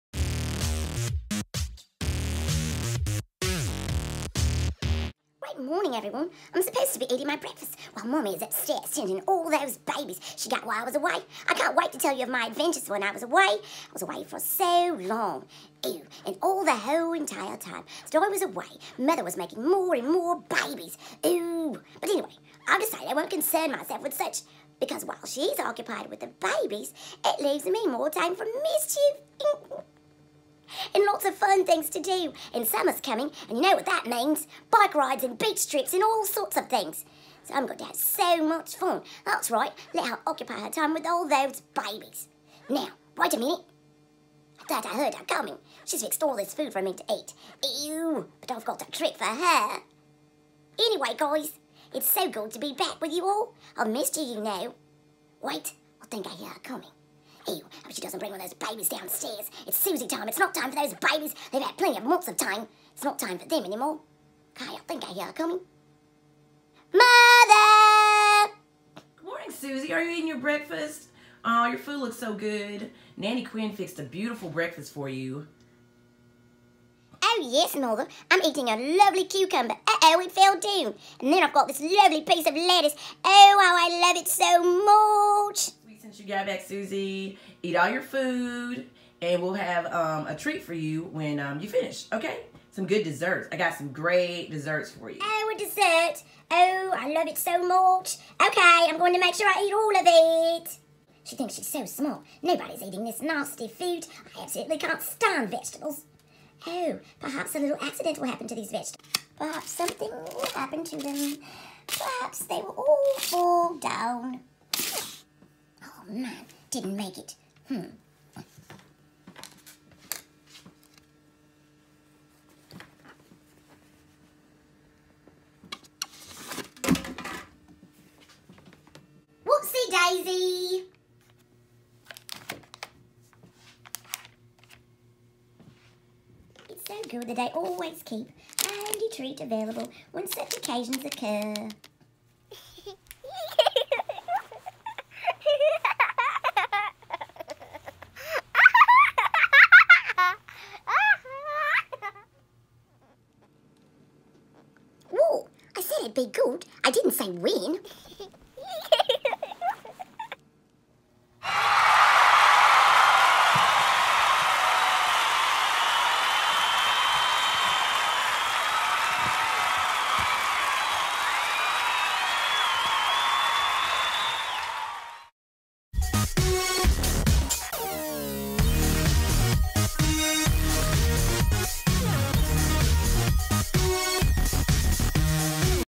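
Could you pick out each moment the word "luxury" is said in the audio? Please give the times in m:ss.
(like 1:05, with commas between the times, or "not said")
not said.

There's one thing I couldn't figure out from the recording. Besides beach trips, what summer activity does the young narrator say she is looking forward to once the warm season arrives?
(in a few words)
bike rides.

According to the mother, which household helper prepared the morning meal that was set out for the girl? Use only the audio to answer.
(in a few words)
Nanny Quinn.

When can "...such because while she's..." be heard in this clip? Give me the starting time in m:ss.
0:24.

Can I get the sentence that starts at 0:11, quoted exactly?
I can't wait to tell you of my adventures when I was away.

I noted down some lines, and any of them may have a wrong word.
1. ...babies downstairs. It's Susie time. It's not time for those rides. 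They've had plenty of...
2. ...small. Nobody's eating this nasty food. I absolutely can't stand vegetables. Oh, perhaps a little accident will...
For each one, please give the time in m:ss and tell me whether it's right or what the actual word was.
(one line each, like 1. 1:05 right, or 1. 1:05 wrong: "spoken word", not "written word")
1. 0:58 wrong: "babies", not "rides"
2. 1:41 right.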